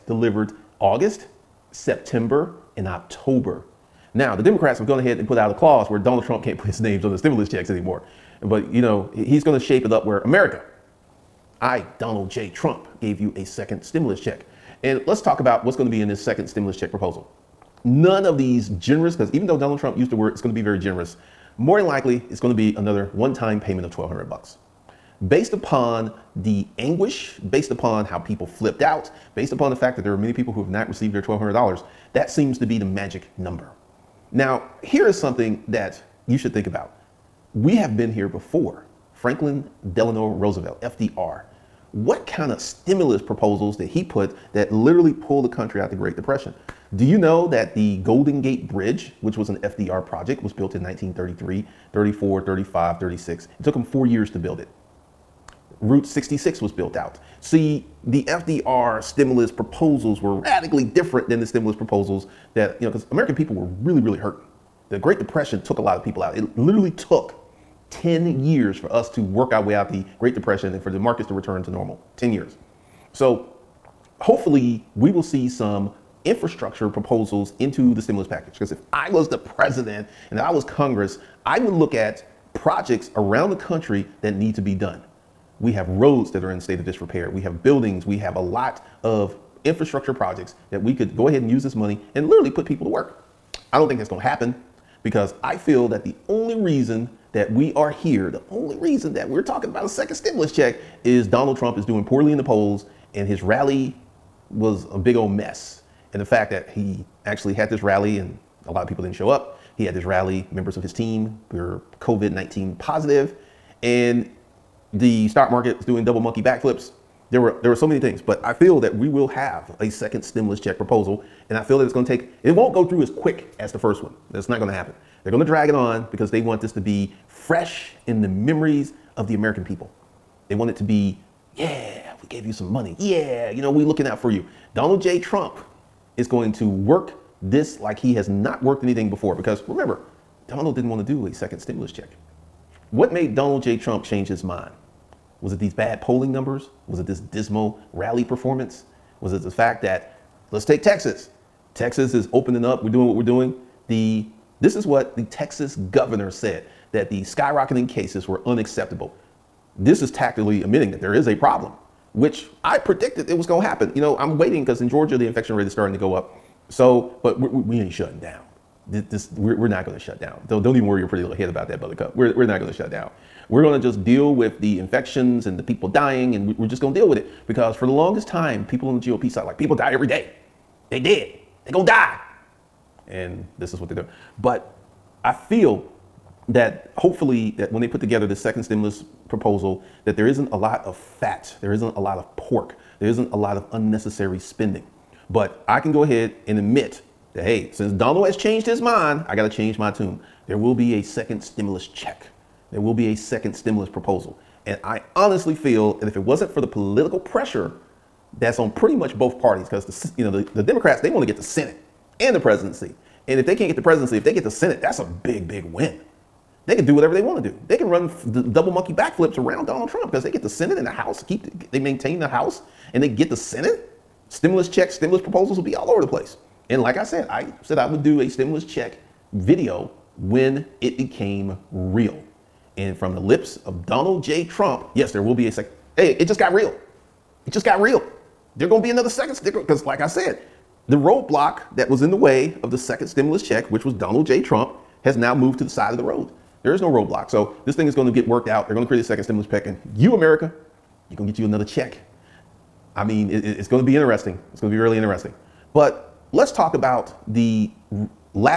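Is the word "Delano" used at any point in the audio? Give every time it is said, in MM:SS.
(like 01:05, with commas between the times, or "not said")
00:39.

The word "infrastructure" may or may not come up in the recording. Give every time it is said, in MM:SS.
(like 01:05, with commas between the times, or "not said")
01:16, 01:29.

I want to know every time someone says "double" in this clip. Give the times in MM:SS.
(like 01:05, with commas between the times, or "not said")
01:56, 03:38.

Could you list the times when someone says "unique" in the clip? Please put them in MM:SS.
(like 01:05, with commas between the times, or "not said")
not said.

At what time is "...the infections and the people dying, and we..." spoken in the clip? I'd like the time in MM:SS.
02:54.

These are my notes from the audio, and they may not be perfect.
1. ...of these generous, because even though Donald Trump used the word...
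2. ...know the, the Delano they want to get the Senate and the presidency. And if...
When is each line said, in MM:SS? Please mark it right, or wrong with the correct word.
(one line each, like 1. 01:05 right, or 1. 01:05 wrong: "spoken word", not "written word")
1. 00:18 right
2. 03:30 wrong: "Democrats", not "Delano".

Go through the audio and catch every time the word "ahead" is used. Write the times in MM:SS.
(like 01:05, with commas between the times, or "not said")
00:04, 01:31, 03:16.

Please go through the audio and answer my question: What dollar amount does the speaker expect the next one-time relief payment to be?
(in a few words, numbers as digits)
$1,200.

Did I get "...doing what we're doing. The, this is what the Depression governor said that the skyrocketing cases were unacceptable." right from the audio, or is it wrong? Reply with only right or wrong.
wrong.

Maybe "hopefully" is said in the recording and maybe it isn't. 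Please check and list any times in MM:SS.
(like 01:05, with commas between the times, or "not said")
01:14, 03:06.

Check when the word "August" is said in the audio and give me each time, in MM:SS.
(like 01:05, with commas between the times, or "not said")
00:00.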